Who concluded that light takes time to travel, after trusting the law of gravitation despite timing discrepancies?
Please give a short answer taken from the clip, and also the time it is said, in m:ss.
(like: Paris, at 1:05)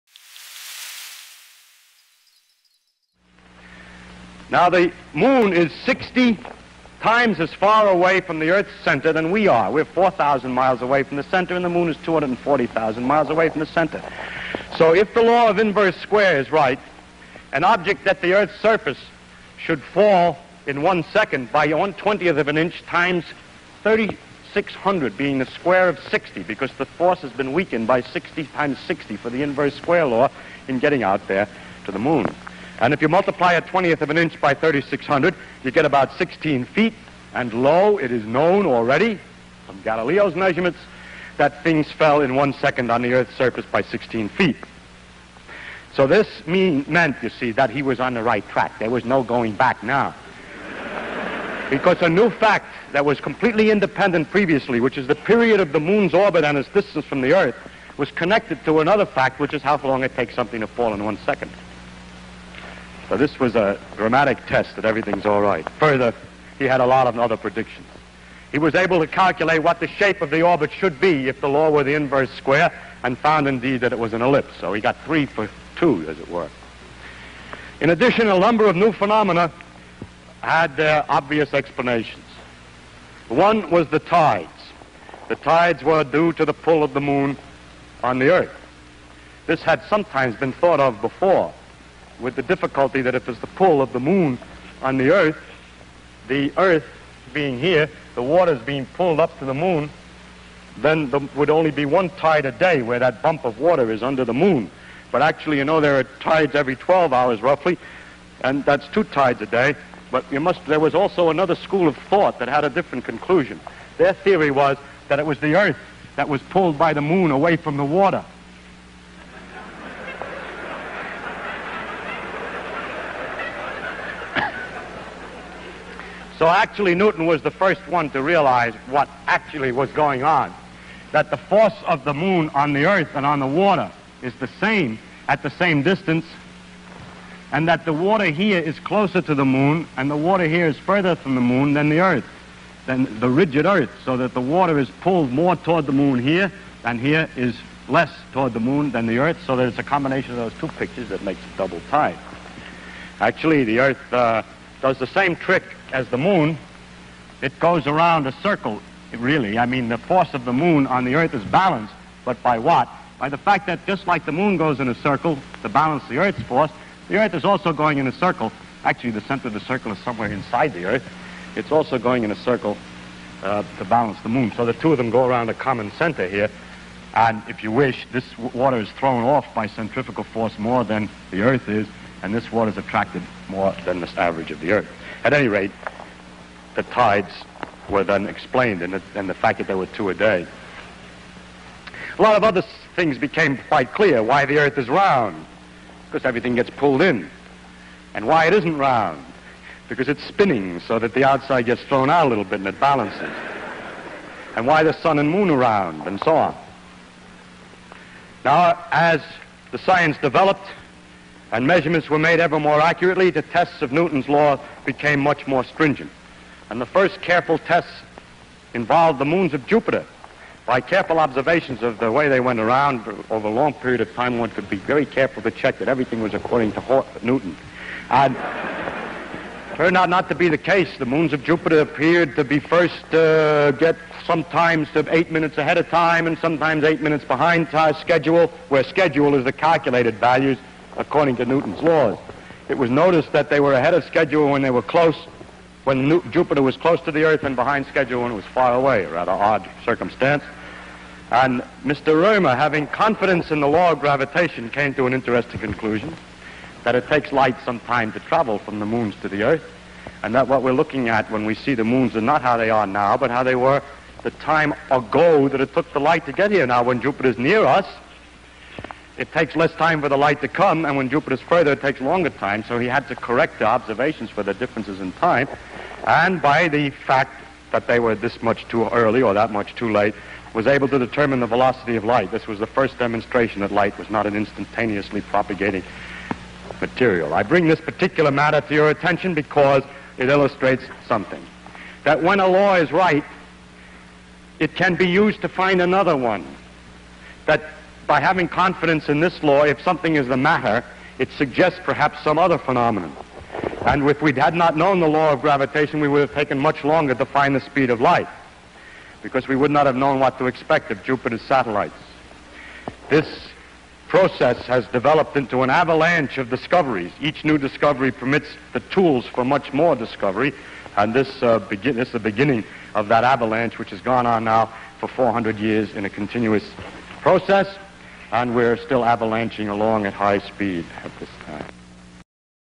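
Römer, at 4:11.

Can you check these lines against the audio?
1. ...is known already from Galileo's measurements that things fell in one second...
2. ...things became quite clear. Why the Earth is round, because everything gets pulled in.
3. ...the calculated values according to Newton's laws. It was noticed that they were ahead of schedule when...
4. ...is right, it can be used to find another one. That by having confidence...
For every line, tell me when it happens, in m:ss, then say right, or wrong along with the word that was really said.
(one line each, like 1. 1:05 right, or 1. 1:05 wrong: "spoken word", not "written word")
1. 0:38 right
2. 3:12 right
3. 3:59 right
4. 4:52 right.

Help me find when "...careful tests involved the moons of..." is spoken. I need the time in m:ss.
3:37.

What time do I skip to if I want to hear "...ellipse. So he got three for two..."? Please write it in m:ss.
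1:14.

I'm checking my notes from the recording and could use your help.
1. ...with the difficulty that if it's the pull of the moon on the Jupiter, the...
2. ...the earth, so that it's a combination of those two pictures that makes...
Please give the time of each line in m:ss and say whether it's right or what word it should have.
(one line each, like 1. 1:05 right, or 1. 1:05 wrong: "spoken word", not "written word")
1. 1:32 wrong: "Earth", not "Jupiter"
2. 2:29 right.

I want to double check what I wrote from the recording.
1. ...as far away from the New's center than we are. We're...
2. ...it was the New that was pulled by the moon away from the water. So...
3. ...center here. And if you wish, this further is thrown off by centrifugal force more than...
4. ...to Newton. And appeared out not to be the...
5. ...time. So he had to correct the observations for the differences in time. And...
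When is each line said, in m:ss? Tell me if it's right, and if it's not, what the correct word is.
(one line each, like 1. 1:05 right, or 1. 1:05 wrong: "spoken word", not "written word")
1. 0:07 wrong: "Earth", not "New"
2. 1:55 wrong: "Earth", not "New"
3. 2:55 wrong: "water", not "further"
4. 3:46 wrong: "turned", not "appeared"
5. 4:32 right.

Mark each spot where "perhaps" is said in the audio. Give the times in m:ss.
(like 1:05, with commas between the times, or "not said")
5:01.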